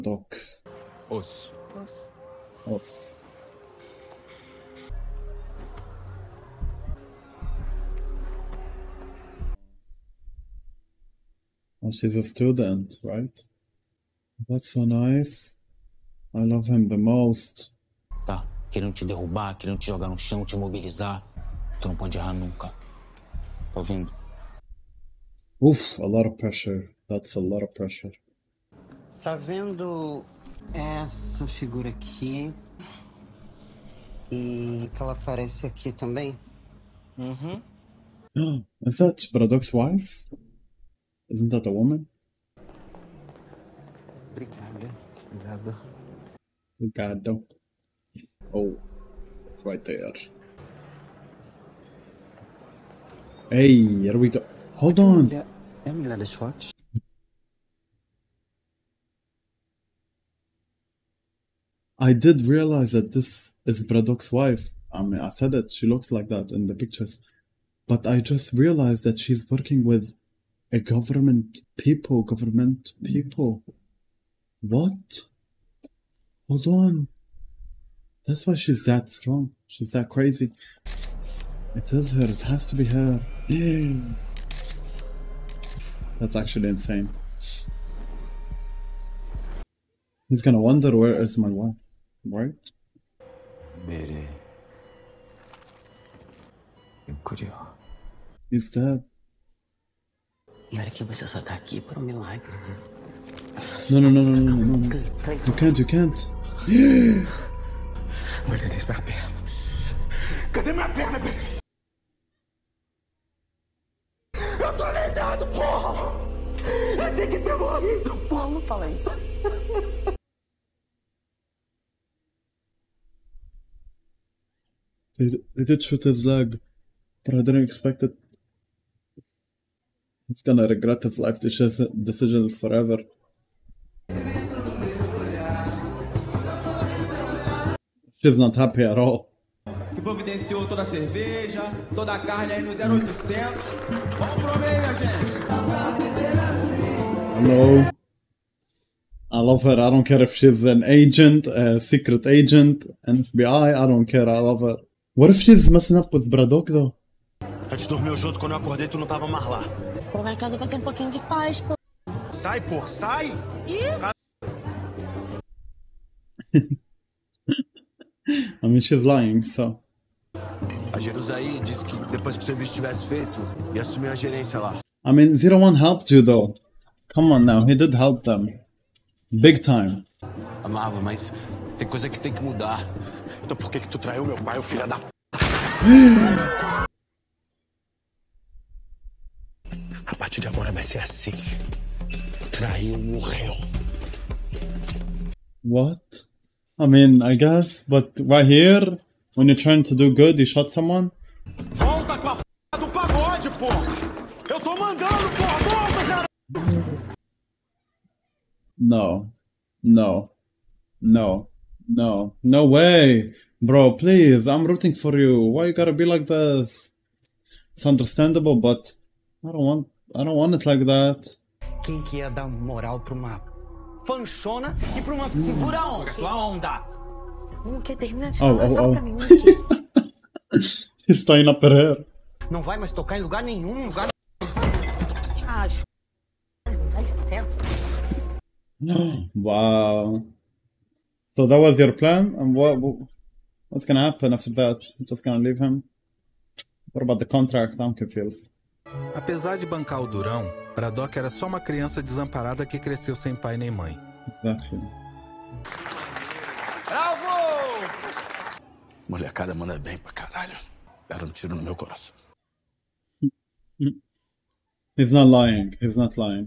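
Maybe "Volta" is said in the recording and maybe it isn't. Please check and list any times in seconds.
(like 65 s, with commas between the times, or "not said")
201 s, 206 s.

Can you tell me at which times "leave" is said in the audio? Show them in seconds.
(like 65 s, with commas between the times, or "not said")
245 s.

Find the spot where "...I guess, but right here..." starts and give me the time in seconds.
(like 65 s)
197 s.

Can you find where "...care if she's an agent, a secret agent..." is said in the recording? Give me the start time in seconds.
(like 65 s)
150 s.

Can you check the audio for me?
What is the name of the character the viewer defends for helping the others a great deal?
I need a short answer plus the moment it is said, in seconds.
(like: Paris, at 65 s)
Zero One, at 175 s.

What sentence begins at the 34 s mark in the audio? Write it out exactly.
E que ela aparece aqui também?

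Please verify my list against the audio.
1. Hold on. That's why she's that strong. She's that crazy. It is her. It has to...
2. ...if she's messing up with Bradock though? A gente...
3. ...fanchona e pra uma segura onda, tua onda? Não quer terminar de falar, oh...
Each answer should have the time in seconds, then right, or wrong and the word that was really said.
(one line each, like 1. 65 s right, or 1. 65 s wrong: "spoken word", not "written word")
1. 76 s right
2. 155 s right
3. 224 s right.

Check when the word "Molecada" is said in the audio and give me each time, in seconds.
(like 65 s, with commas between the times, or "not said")
259 s.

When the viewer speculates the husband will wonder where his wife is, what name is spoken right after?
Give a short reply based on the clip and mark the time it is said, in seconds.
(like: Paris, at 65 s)
Mary, at 93 s.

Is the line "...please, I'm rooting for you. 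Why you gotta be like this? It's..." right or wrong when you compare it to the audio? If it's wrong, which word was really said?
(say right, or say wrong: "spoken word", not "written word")
right.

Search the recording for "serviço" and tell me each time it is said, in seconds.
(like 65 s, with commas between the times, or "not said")
172 s.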